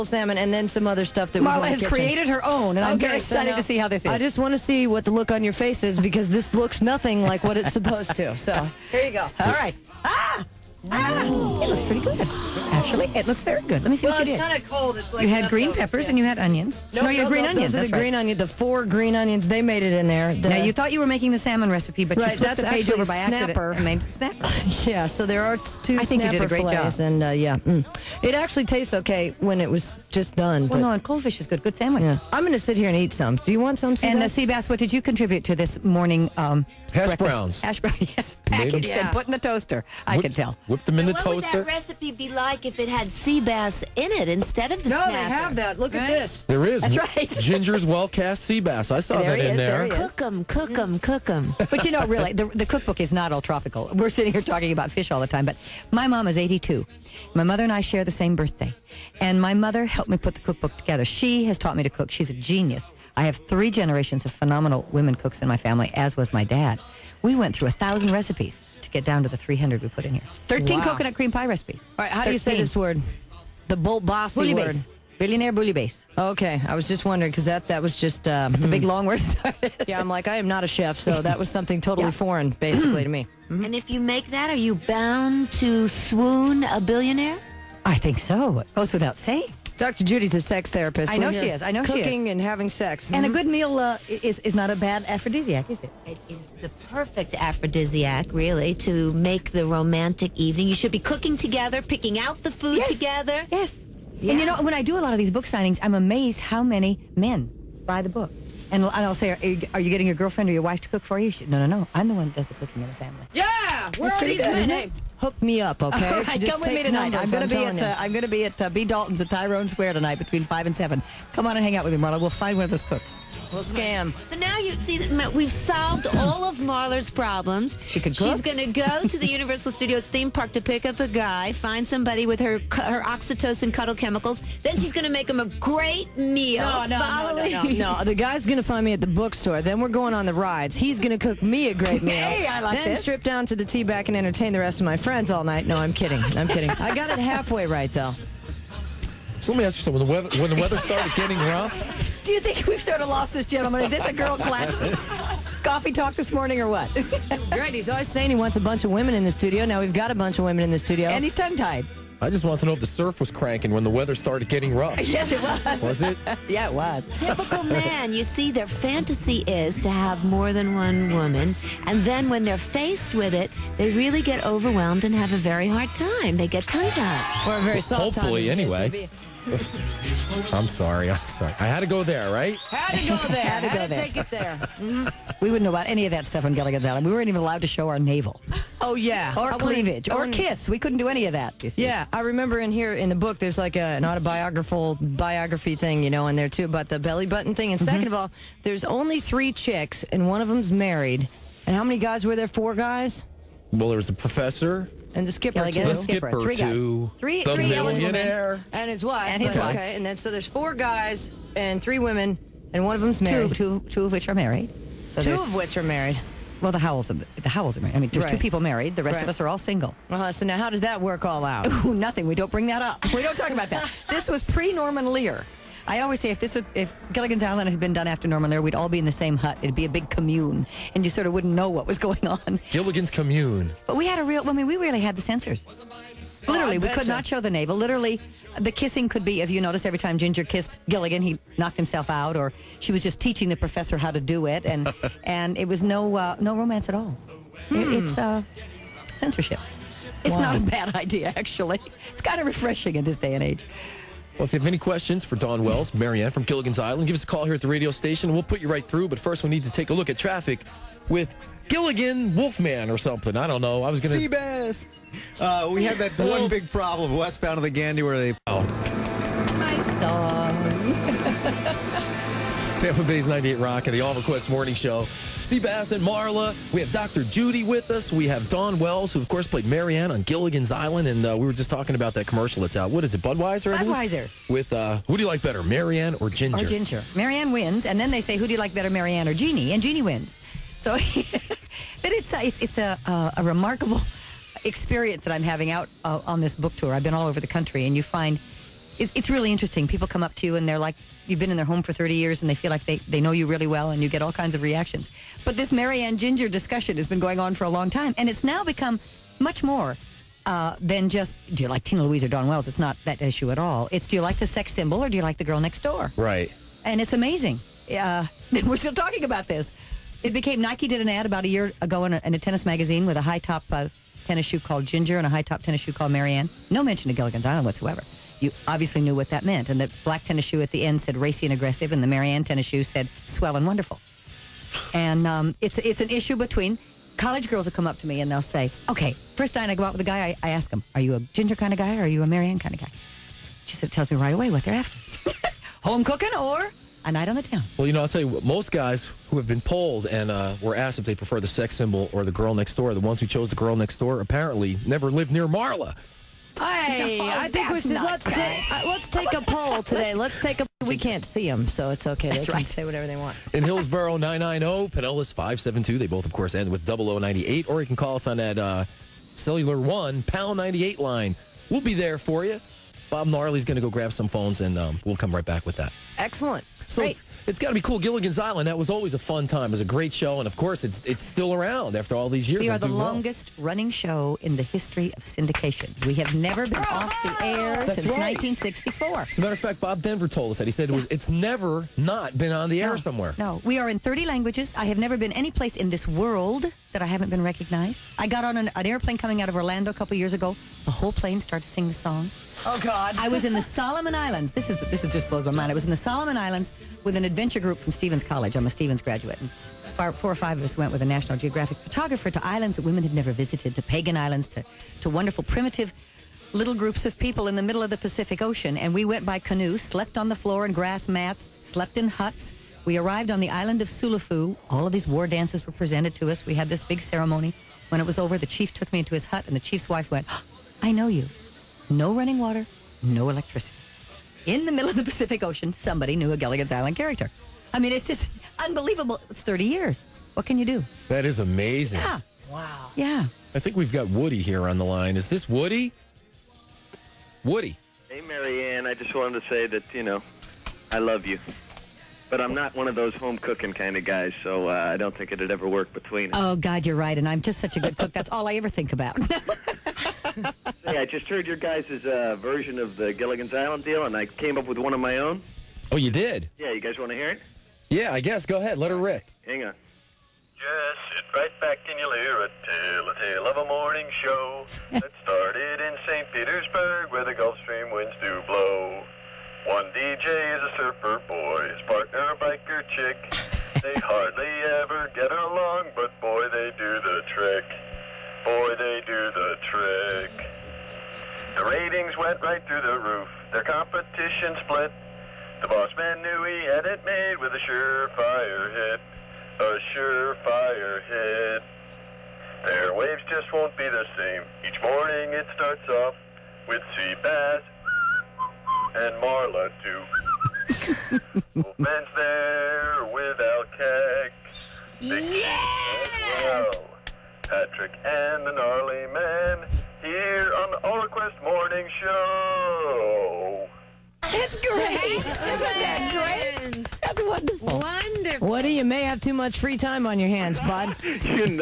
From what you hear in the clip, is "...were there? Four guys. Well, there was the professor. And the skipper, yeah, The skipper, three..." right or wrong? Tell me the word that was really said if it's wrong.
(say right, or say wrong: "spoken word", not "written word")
right.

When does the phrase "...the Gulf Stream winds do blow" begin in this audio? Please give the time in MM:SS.
07:57.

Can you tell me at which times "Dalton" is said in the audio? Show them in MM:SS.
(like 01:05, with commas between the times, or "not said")
01:58.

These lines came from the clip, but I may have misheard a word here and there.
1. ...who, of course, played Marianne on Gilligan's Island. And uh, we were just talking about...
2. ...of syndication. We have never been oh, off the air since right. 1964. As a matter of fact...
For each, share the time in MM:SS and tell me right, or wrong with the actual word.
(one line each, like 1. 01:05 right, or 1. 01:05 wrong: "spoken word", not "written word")
1. 04:39 right
2. 06:25 right.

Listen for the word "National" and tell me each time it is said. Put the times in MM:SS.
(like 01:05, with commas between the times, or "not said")
06:51.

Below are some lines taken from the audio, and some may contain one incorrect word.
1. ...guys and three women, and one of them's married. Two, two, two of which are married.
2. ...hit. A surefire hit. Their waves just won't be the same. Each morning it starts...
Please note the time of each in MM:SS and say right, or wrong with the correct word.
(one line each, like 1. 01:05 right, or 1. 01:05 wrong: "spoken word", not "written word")
1. 03:30 right
2. 08:18 right.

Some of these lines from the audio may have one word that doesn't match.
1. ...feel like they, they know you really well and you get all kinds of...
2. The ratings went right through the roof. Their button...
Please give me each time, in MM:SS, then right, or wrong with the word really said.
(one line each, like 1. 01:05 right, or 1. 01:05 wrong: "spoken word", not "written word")
1. 05:02 right
2. 08:11 wrong: "competition", not "button".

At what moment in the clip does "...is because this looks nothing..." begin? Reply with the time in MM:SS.
00:05.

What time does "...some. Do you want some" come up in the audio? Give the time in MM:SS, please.
00:33.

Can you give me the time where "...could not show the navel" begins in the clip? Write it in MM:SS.
03:56.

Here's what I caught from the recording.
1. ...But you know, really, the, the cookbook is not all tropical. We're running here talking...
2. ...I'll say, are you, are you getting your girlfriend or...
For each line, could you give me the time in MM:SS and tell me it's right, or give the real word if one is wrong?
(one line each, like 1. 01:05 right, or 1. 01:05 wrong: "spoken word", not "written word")
1. 00:51 wrong: "sitting", not "running"
2. 01:48 right.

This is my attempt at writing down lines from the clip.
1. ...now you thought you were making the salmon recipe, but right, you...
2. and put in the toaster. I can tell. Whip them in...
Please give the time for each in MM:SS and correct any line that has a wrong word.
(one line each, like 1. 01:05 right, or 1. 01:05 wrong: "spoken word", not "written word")
1. 00:20 right
2. 00:39 right.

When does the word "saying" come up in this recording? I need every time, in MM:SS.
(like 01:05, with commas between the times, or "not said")
01:29, 02:38.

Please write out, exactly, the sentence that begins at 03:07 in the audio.
We weren't even allowed to show our navel.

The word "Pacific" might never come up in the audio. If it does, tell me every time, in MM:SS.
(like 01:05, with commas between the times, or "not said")
06:57, 07:15.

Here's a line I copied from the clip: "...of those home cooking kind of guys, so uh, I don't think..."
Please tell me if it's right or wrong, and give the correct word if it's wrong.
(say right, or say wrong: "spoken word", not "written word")
right.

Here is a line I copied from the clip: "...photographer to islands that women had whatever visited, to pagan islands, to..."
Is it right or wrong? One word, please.
wrong.